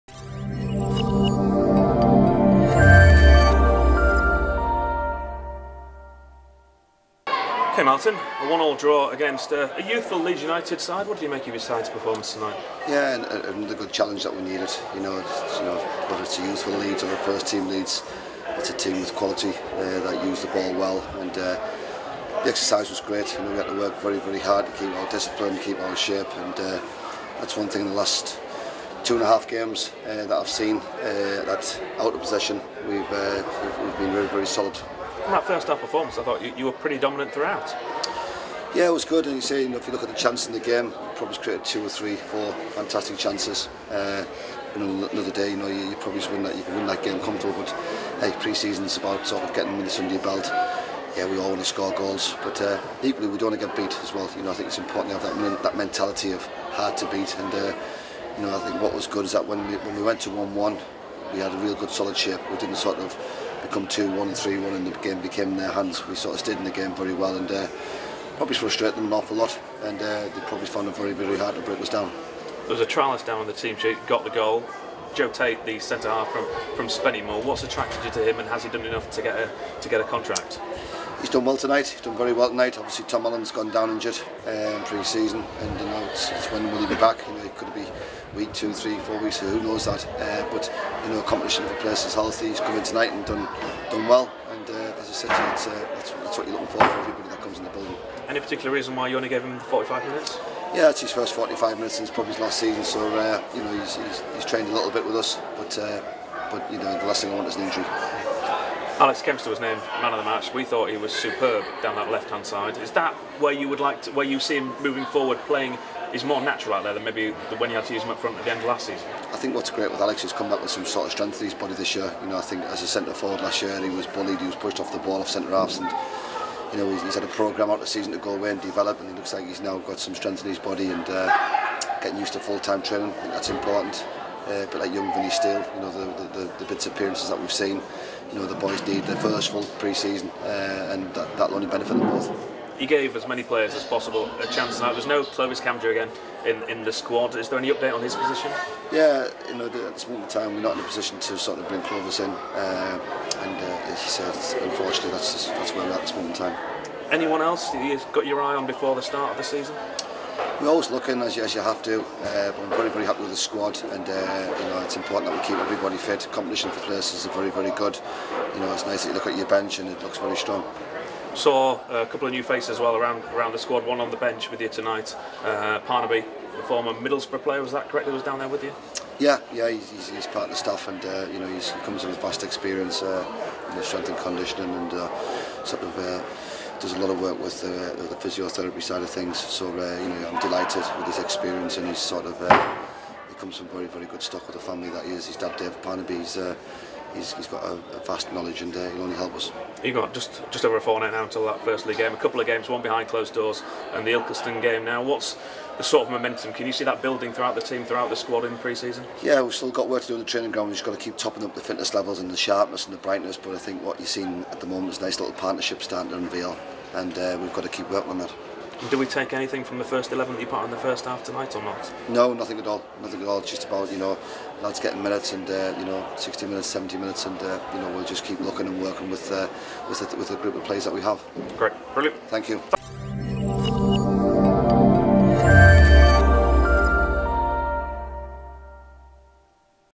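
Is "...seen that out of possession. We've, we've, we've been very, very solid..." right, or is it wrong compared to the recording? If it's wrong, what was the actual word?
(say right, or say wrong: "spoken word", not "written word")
right.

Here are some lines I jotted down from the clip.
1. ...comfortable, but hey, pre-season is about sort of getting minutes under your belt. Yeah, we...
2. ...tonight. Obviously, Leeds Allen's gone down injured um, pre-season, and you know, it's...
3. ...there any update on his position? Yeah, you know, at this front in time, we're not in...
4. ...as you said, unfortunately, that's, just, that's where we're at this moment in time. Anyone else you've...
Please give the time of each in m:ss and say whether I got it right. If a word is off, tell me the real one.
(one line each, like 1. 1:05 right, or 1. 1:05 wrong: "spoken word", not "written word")
1. 0:47 right
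2. 1:22 wrong: "Tom", not "Leeds"
3. 2:27 wrong: "moment", not "front"
4. 2:33 right.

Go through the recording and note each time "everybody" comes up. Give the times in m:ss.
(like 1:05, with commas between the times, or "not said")
1:36, 2:45.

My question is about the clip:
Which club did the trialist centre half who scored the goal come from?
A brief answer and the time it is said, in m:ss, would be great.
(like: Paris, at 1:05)
Spennymoor, at 1:16.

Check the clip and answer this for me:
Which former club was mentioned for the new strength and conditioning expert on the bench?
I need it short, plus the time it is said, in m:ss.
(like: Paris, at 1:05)
Middlesbrough, at 2:56.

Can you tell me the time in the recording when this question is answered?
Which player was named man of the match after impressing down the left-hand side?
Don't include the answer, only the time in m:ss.
1:49.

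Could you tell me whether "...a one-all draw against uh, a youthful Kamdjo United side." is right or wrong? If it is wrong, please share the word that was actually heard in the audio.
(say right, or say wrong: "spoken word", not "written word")
wrong: "Leeds", not "Kamdjo".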